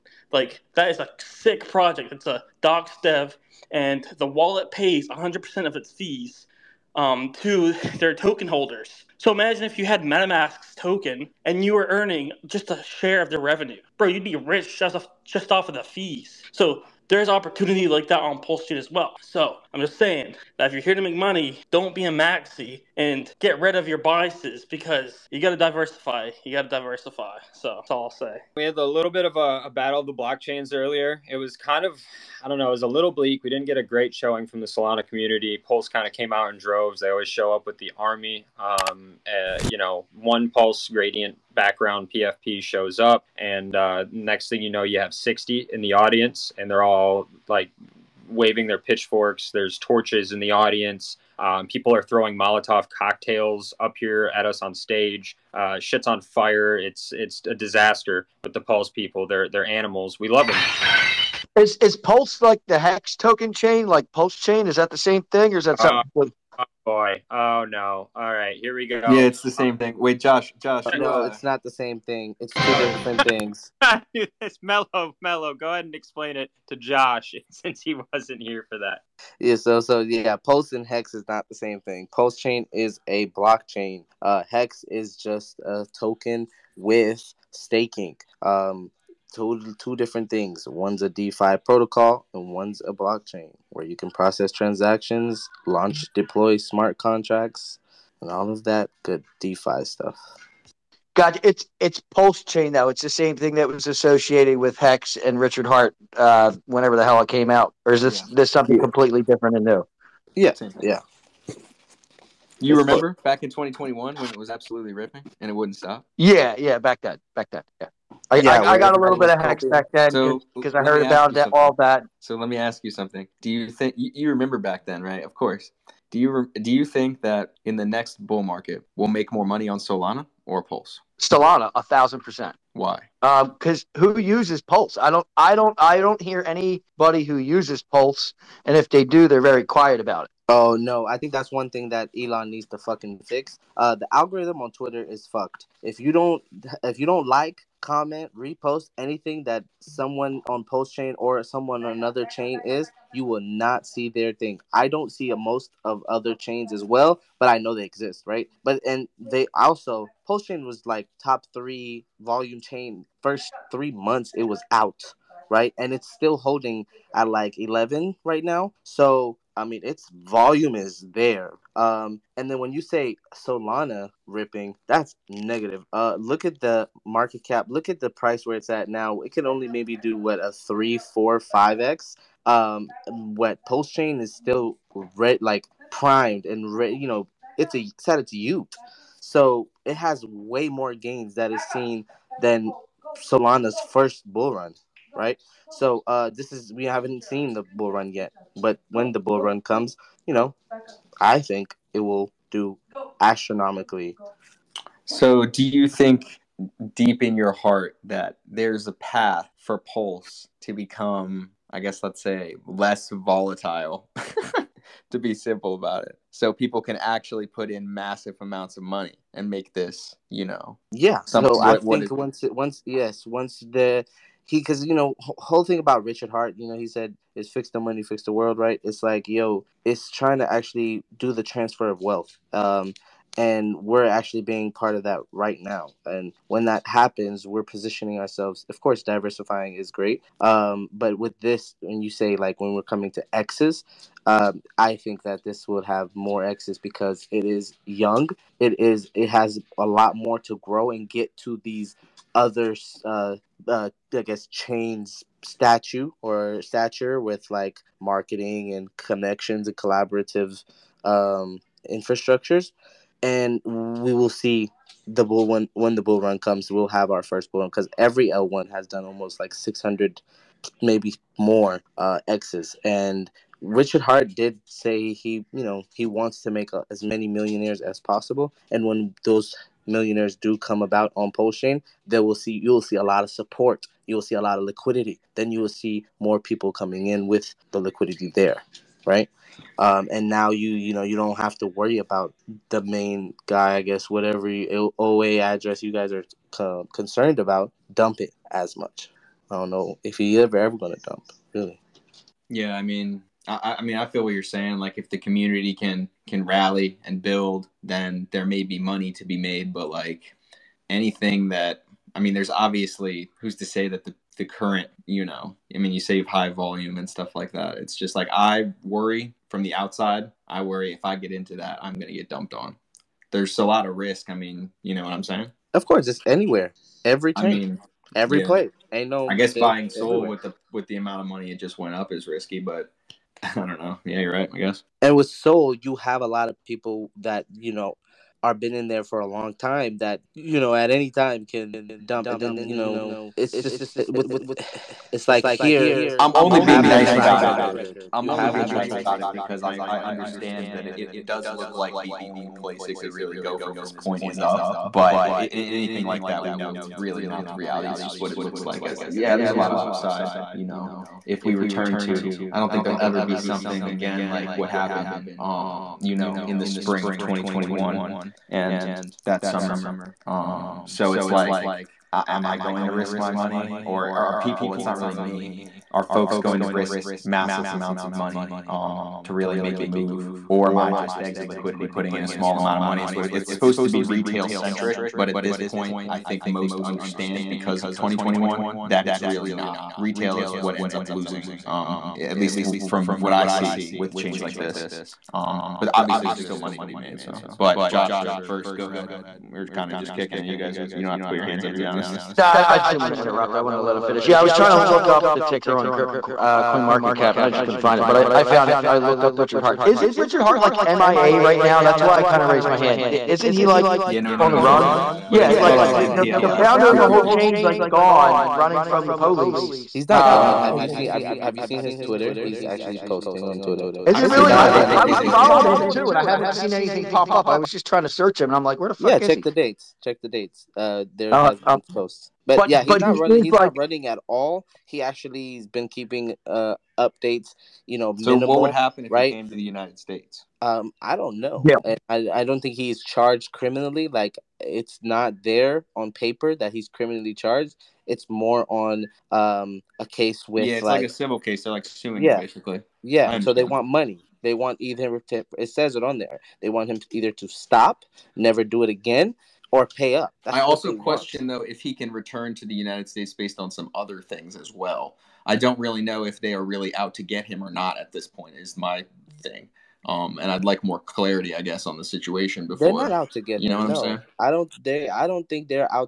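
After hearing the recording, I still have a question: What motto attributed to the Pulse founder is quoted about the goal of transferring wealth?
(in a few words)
Fix the money, fix the world.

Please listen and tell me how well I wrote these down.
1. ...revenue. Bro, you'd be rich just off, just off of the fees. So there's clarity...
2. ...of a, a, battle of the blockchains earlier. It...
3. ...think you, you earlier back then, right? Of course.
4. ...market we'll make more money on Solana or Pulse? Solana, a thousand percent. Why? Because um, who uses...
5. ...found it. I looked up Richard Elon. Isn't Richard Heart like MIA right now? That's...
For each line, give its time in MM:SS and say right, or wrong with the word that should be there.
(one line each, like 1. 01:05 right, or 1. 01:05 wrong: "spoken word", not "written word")
1. 00:13 wrong: "opportunity", not "clarity"
2. 00:29 right
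3. 02:03 wrong: "remember", not "earlier"
4. 02:08 right
5. 06:48 wrong: "Heart", not "Elon".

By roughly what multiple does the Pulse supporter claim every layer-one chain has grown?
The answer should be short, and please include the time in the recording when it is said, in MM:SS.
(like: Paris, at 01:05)
600, at 04:29.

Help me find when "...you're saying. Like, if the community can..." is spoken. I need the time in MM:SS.
05:04.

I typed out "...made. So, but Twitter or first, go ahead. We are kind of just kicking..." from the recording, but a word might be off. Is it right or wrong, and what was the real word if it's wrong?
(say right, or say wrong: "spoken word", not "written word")
wrong: "Josh", not "Twitter".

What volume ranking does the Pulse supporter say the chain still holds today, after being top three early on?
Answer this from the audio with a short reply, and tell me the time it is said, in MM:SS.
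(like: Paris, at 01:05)
11, at 02:47.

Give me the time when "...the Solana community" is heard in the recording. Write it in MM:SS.
00:34.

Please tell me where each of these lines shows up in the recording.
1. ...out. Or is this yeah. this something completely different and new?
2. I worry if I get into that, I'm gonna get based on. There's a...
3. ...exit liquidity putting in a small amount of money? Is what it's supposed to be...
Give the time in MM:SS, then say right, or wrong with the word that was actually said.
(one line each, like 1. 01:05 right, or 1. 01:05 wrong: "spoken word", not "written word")
1. 01:47 right
2. 05:20 wrong: "dumped", not "based"
3. 06:21 right.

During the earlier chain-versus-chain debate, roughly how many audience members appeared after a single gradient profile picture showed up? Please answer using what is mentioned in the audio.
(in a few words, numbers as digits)
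60.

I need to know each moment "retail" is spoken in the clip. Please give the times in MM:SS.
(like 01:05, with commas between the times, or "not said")
06:24, 06:29.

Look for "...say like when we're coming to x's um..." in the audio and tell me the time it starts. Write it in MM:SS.
04:02.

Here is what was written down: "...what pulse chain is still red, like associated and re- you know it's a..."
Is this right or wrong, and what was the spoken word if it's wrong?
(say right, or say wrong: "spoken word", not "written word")
wrong: "primed", not "associated".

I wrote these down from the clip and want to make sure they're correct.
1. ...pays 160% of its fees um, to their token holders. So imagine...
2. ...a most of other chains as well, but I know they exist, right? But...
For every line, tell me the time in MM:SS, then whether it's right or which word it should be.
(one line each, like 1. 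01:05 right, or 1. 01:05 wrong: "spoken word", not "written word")
1. 00:04 wrong: "100", not "160"
2. 02:35 right.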